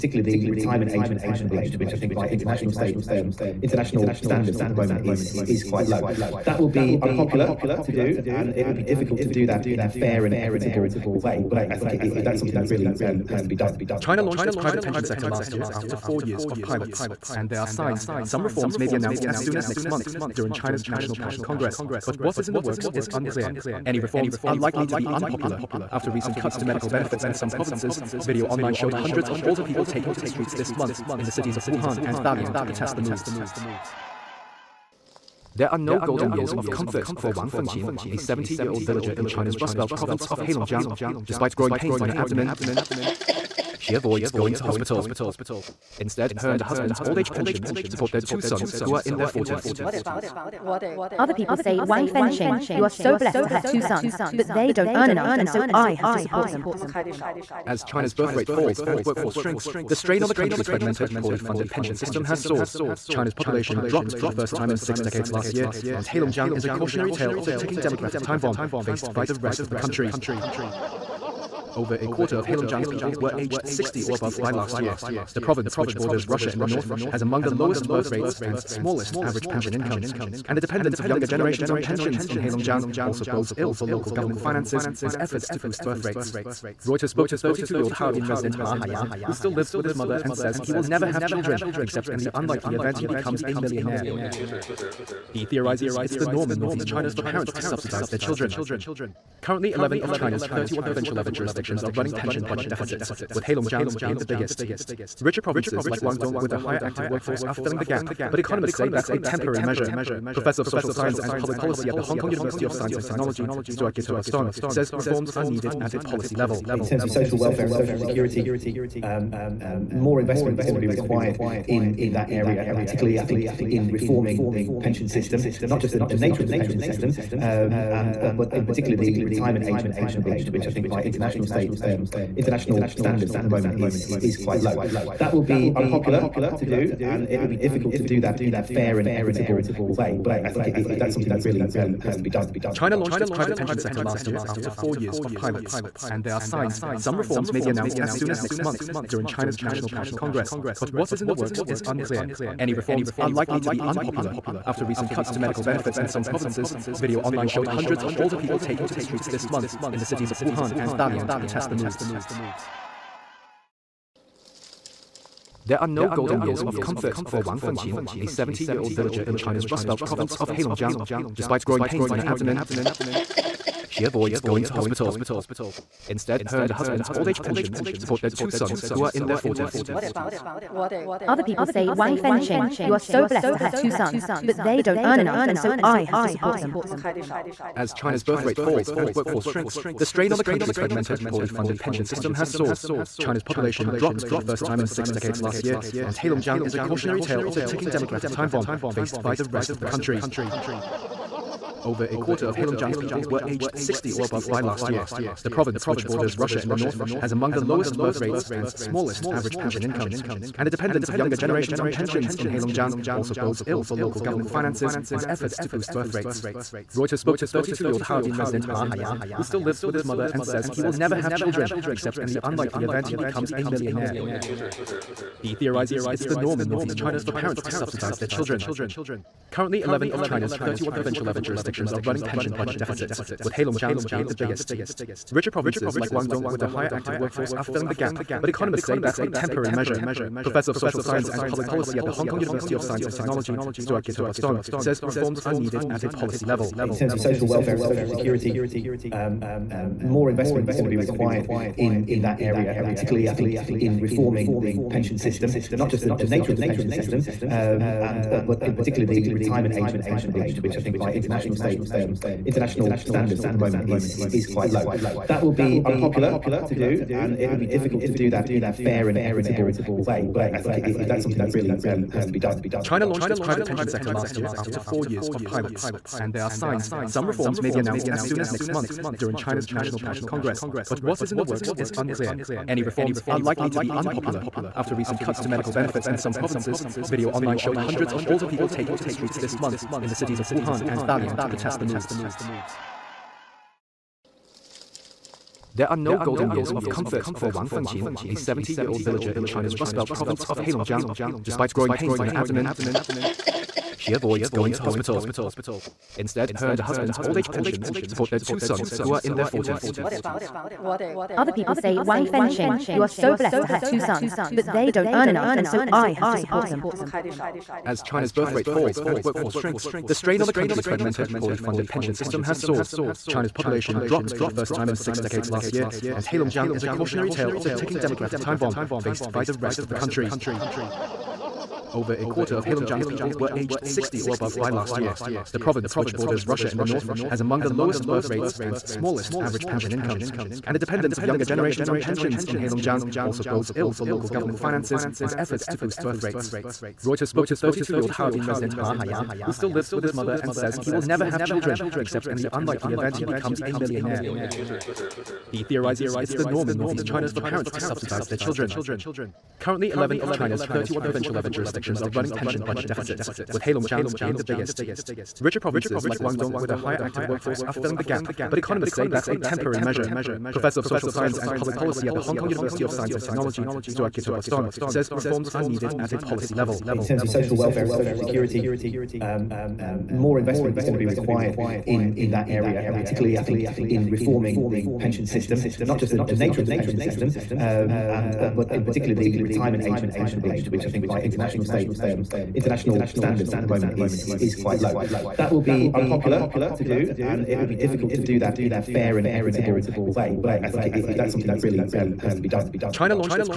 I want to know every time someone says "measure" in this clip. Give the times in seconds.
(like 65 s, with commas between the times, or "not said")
109 s, 239 s, 369 s.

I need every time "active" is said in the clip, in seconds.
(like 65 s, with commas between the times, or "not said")
106 s, 236 s, 367 s.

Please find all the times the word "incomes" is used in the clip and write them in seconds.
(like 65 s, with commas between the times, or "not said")
79 s, 209 s, 339 s.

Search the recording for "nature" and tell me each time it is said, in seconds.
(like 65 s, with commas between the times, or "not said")
126 s, 256 s, 386 s.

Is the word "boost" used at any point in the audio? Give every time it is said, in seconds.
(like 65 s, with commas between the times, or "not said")
85 s, 215 s, 345 s.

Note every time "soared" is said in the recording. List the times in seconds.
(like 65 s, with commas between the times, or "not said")
62 s, 192 s, 322 s.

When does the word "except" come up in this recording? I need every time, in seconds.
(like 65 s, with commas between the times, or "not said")
91 s, 221 s, 351 s.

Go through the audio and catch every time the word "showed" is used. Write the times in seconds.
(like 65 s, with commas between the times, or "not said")
28 s, 157 s, 287 s.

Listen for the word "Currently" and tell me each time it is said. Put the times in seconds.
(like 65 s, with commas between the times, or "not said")
99 s, 229 s, 359 s.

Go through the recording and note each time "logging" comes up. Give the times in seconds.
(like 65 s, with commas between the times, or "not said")
not said.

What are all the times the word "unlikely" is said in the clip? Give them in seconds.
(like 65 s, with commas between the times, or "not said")
92 s, 222 s, 352 s.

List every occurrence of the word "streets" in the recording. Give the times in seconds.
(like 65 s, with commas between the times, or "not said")
30 s, 159 s, 289 s.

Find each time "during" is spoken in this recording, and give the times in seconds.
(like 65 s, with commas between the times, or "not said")
20 s, 149 s, 279 s.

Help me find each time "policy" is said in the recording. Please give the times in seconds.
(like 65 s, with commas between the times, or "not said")
111 s, 115 s, 241 s, 246 s, 371 s, 376 s.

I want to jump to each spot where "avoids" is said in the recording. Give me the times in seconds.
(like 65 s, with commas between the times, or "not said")
43 s, 174 s, 304 s.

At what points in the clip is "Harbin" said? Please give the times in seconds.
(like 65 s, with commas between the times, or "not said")
87 s, 218 s, 348 s.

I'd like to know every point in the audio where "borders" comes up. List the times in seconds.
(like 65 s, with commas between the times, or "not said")
75 s, 206 s, 336 s.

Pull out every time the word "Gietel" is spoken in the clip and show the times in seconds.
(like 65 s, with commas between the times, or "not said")
113 s, 244 s, 374 s.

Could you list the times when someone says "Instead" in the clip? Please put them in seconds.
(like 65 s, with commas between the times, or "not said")
45 s, 176 s, 306 s.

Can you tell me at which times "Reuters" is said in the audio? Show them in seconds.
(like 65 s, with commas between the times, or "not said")
86 s, 216 s, 347 s.